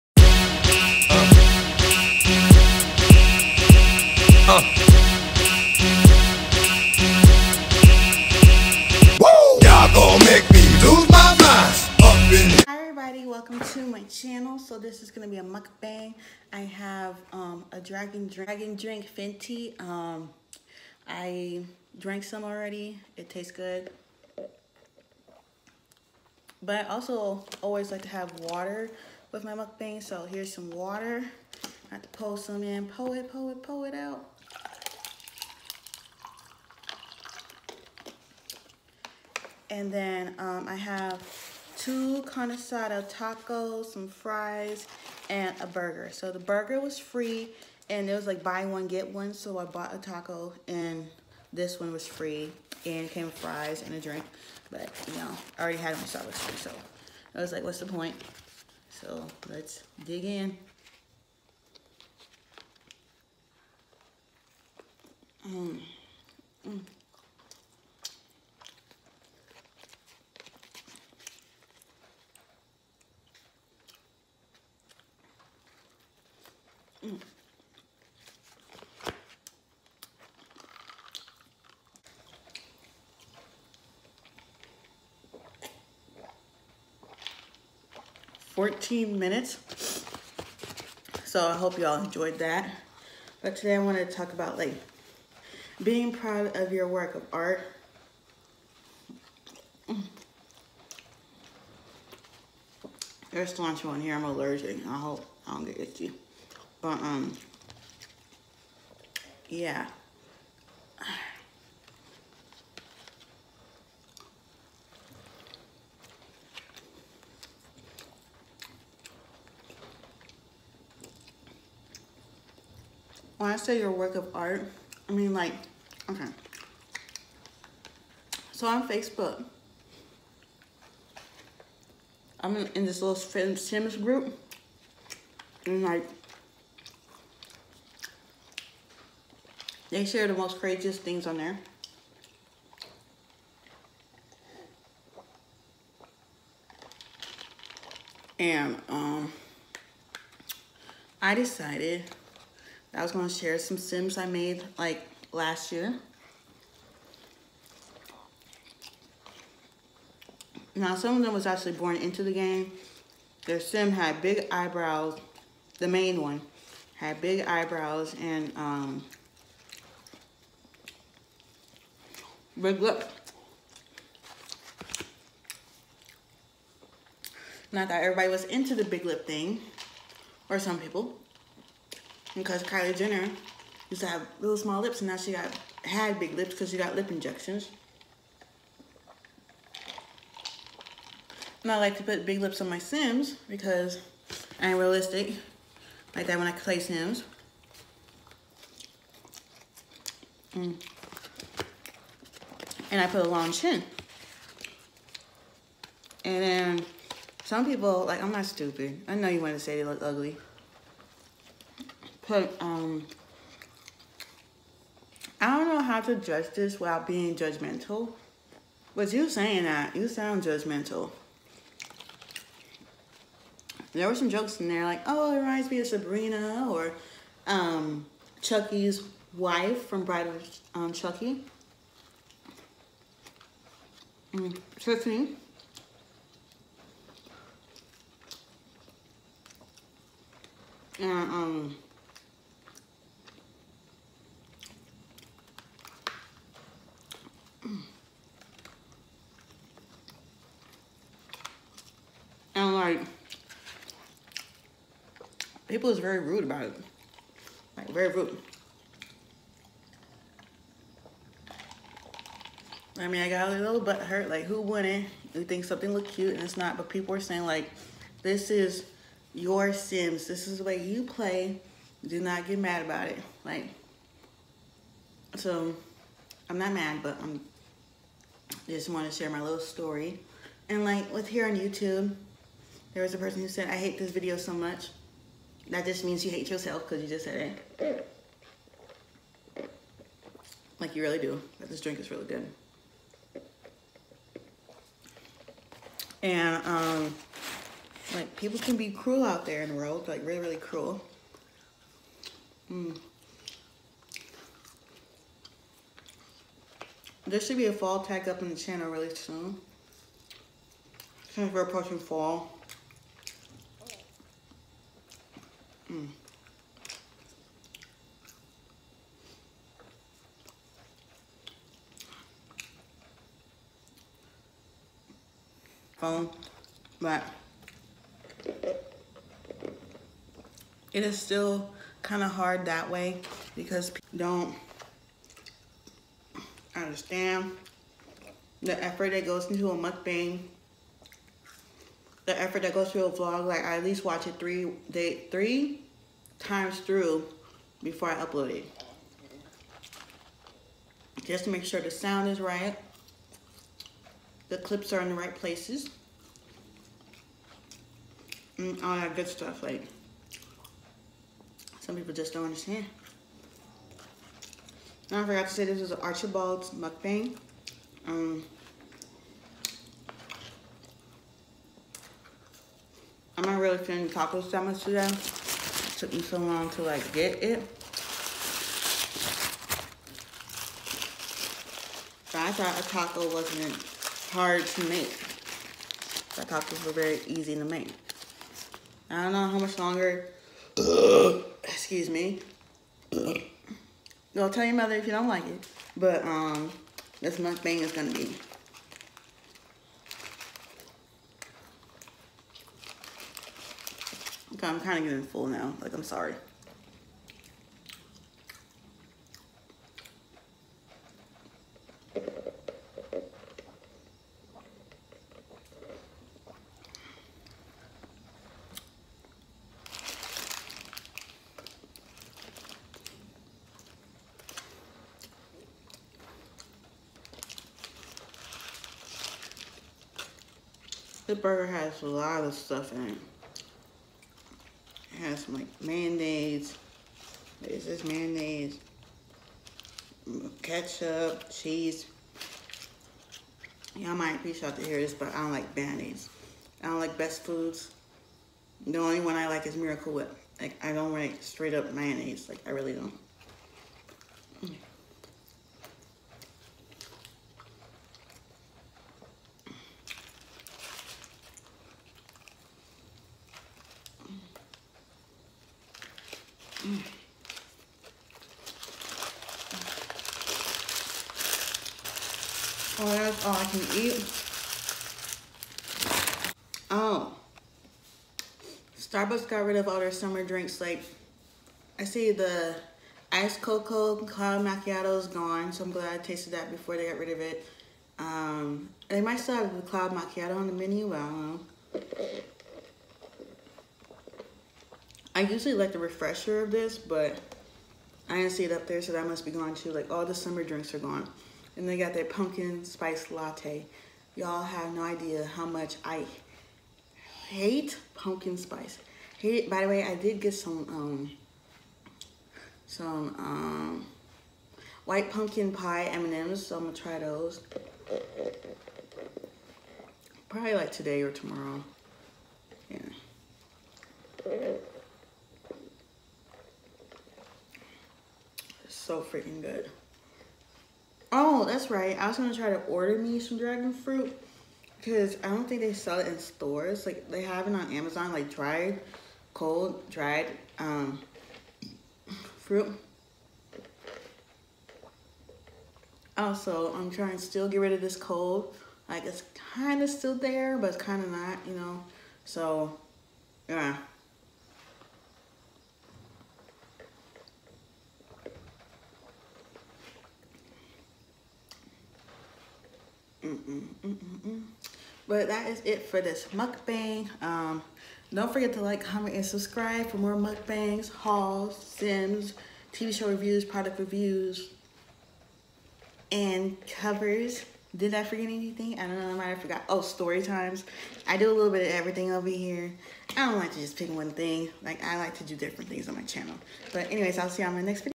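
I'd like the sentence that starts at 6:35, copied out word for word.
But um, this mukbang is gonna be.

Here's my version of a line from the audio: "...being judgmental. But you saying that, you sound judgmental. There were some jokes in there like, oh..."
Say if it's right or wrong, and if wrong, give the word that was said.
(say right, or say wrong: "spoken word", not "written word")
right.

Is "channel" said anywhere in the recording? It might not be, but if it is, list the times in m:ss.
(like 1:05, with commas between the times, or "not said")
0:14, 5:08, 9:46.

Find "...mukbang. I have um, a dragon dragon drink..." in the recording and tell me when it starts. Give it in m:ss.
0:15.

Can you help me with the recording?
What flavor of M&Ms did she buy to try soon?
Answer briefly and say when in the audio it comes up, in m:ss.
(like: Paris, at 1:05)
white pumpkin pie, at 8:35.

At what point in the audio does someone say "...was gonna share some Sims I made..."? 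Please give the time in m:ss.
2:33.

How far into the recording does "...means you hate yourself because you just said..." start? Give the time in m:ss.
4:46.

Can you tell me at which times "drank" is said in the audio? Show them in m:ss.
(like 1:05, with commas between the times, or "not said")
0:21.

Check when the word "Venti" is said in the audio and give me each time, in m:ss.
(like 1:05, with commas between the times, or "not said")
0:19.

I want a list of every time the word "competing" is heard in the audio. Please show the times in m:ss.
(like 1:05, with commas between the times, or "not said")
not said.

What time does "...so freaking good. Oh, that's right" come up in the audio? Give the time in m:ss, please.
8:48.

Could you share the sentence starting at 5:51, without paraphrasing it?
Just to make sure the sound is right.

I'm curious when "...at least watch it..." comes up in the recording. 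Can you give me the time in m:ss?
5:43.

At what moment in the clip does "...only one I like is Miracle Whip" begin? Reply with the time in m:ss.
7:28.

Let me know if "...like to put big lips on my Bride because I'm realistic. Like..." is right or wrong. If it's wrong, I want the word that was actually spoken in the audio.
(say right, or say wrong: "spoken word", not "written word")
wrong: "Sims", not "Bride".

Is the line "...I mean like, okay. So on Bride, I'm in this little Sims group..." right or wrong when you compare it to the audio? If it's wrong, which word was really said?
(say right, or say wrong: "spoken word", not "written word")
wrong: "Facebook", not "Bride".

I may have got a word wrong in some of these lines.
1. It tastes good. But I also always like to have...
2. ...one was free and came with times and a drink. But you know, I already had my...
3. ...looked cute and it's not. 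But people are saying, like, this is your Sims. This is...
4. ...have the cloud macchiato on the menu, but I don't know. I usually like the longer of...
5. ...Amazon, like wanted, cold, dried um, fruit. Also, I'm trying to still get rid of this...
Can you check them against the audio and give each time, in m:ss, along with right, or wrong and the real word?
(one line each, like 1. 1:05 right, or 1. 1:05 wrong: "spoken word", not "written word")
1. 0:23 right
2. 0:51 wrong: "fries", not "times"
3. 4:25 right
4. 8:09 wrong: "refresher", not "longer"
5. 8:57 wrong: "dried", not "wanted".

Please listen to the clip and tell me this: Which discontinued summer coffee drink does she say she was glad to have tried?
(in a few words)
iced cocoa cloud macchiato.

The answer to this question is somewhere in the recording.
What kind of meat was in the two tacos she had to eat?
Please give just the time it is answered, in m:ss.
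0:42.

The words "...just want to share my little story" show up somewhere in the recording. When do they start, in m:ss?
4:38.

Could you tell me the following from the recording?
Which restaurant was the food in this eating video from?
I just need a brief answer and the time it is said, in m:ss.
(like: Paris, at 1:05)
Archibald's, at 6:06.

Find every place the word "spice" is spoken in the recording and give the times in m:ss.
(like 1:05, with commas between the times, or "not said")
8:22, 8:28.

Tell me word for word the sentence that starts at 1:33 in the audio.
But today I wanted to talk about like being proud of your work of art.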